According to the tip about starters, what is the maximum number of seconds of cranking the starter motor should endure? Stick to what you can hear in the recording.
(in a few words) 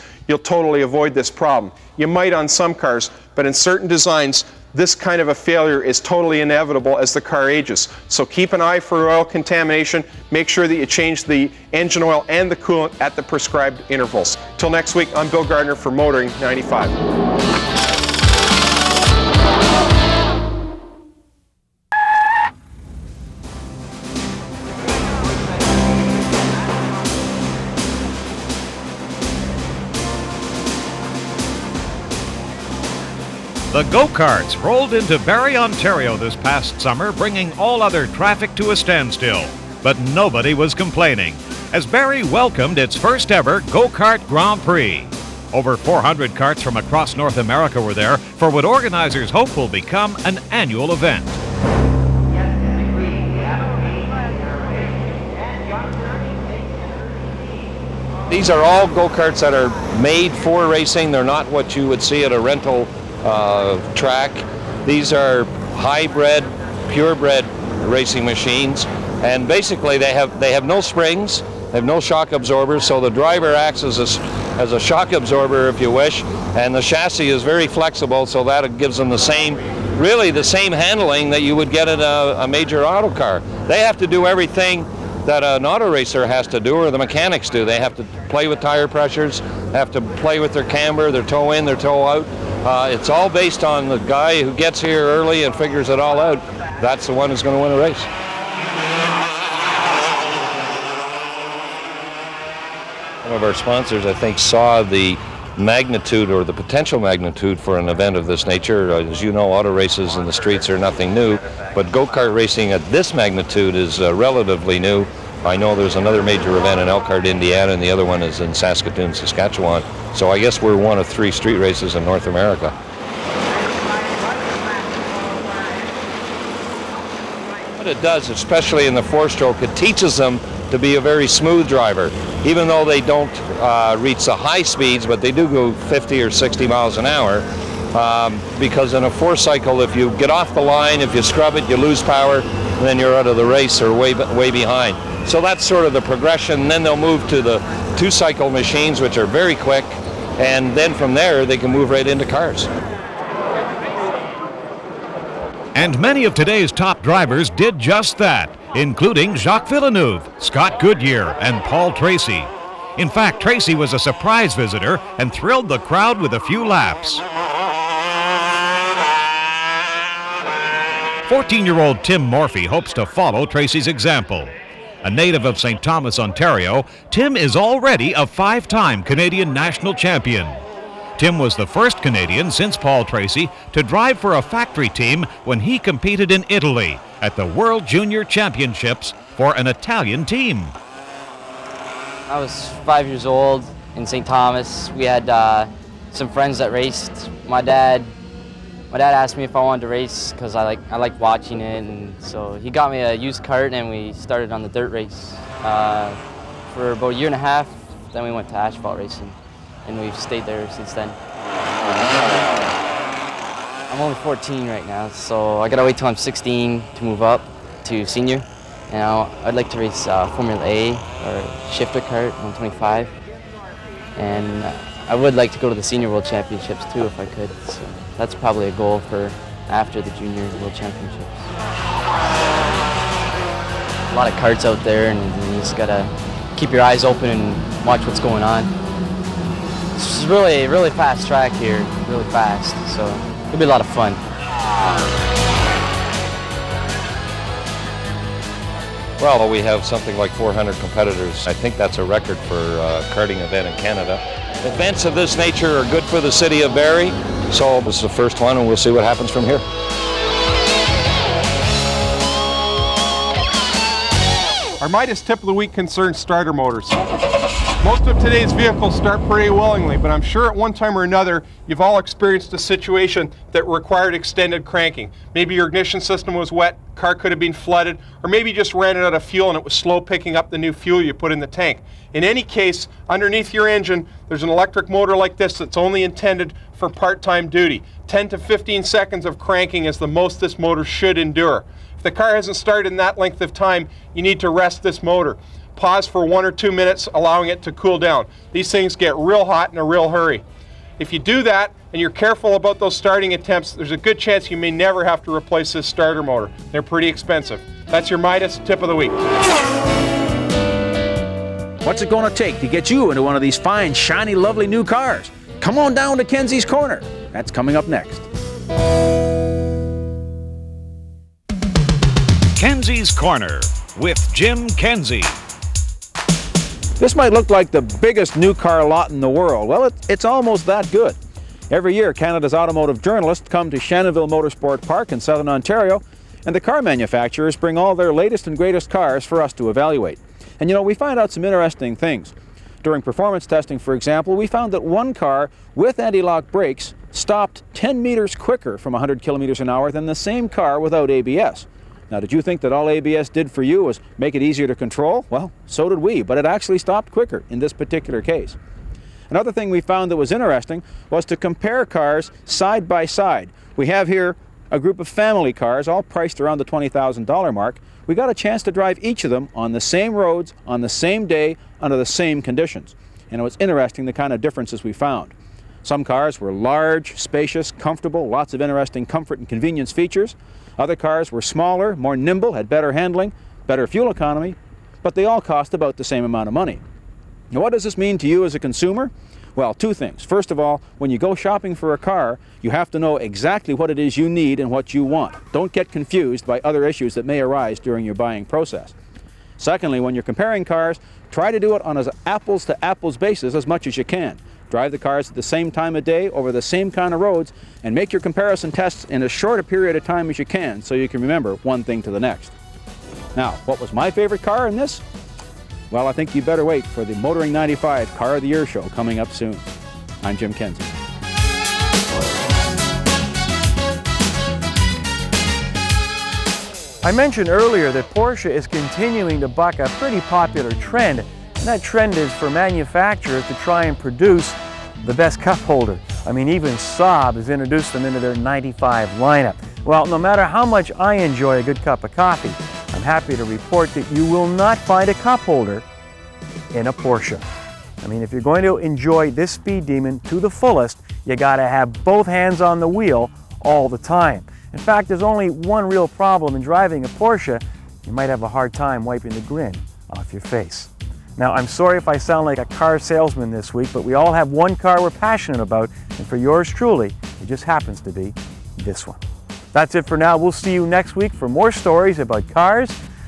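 15.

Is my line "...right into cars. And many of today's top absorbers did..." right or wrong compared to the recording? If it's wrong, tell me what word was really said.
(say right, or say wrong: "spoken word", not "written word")
wrong: "drivers", not "absorbers".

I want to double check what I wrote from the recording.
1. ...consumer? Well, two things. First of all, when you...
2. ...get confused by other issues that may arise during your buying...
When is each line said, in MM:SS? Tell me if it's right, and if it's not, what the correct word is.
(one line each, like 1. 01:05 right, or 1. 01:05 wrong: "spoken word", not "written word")
1. 06:28 right
2. 06:35 right.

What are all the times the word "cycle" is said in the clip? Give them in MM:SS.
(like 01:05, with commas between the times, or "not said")
02:19, 02:28.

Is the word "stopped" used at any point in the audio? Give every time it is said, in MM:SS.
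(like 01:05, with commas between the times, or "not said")
05:47, 05:56.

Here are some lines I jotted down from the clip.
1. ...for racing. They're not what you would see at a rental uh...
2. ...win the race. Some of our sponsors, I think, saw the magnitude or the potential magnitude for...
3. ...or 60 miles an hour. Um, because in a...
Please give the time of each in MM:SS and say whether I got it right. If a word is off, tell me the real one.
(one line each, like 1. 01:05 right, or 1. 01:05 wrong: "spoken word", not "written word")
1. 01:00 right
2. 01:37 right
3. 02:16 right.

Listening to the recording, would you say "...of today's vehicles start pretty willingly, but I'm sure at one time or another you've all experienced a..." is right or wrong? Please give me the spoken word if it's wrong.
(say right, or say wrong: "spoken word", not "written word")
right.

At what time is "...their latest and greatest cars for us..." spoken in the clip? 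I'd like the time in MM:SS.
05:37.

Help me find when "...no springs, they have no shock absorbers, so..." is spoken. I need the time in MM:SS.
01:10.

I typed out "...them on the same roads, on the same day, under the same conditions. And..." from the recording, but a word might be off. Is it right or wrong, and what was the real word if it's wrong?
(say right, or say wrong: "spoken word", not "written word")
right.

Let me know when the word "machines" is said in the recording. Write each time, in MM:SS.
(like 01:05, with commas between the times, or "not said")
01:08, 02:28.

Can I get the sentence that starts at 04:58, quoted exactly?
These things get real hot in a real hurry.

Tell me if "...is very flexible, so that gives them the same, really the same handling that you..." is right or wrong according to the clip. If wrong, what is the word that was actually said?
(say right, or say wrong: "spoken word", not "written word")
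right.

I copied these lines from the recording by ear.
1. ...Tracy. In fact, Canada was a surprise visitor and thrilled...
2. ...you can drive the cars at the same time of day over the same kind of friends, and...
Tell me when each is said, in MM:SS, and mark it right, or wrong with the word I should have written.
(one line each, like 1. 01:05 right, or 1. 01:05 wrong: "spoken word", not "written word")
1. 02:41 wrong: "Tracy", not "Canada"
2. 06:43 wrong: "roads", not "friends".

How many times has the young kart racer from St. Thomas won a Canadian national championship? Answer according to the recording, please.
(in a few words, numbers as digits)
5.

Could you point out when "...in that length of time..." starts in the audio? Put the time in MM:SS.
04:52.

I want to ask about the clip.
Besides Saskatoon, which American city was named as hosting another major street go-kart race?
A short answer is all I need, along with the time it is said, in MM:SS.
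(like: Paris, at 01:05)
Elkhart, Indiana, at 01:56.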